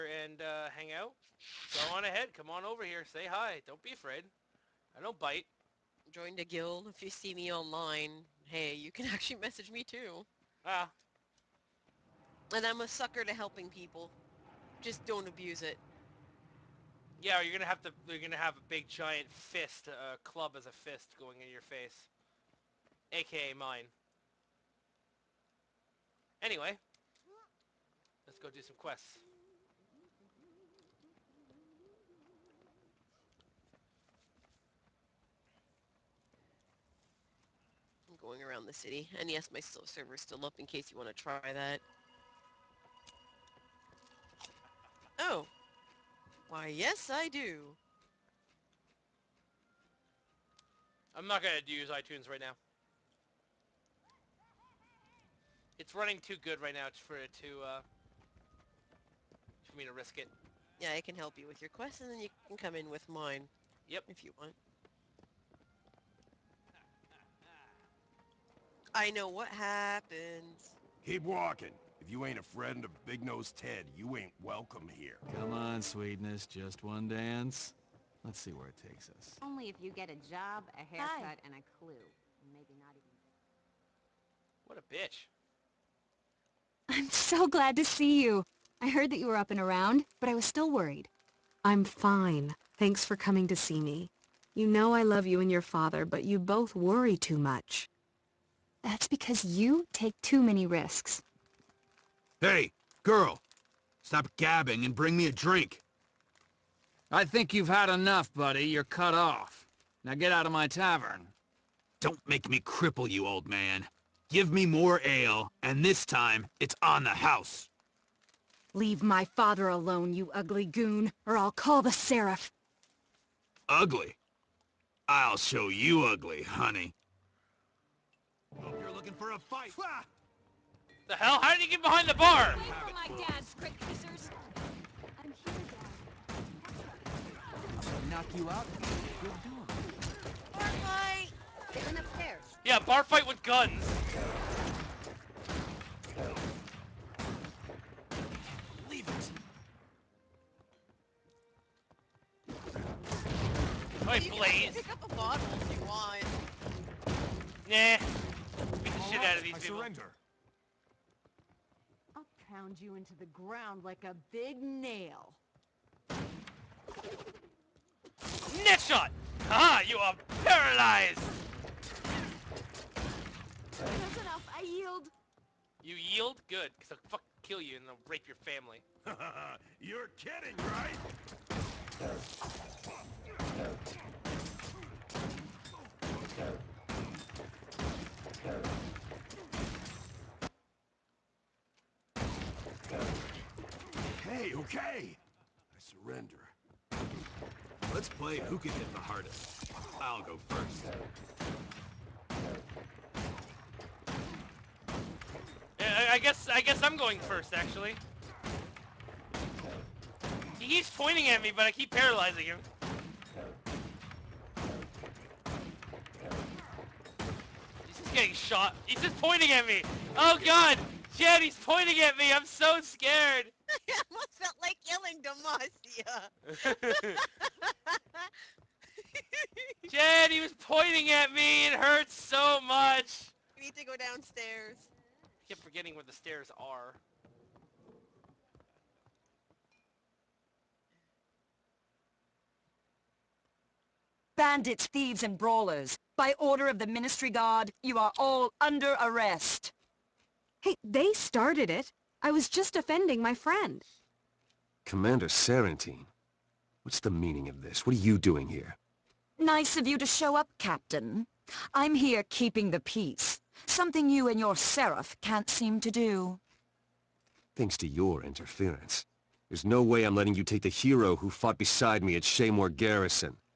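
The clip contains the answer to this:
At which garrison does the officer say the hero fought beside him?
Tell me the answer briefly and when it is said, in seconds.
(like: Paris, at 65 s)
Shaemoor Garrison, at 272 s.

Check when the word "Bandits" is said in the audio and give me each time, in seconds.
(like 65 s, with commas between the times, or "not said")
244 s.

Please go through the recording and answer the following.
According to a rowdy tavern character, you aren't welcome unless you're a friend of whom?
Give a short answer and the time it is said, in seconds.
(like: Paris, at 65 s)
Big Nose Ted, at 73 s.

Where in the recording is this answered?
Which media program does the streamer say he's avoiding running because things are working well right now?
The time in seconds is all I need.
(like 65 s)
51 s.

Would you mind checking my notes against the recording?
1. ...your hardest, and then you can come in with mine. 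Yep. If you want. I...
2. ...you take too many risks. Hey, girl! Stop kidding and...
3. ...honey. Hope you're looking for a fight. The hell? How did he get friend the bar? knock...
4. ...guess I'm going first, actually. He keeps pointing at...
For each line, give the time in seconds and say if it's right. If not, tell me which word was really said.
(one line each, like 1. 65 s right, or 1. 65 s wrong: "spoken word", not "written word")
1. 61 s wrong: "quest", not "hardest"
2. 99 s wrong: "gabbing", not "kidding"
3. 126 s wrong: "behind", not "friend"
4. 206 s right.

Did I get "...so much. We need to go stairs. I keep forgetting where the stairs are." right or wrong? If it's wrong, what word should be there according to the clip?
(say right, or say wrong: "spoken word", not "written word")
wrong: "downstairs", not "stairs".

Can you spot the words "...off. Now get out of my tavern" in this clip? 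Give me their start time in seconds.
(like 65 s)
109 s.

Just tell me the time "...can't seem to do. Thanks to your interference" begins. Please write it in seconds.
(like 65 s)
265 s.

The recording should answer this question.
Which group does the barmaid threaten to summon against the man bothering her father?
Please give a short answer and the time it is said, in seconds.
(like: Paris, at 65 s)
the Seraph, at 121 s.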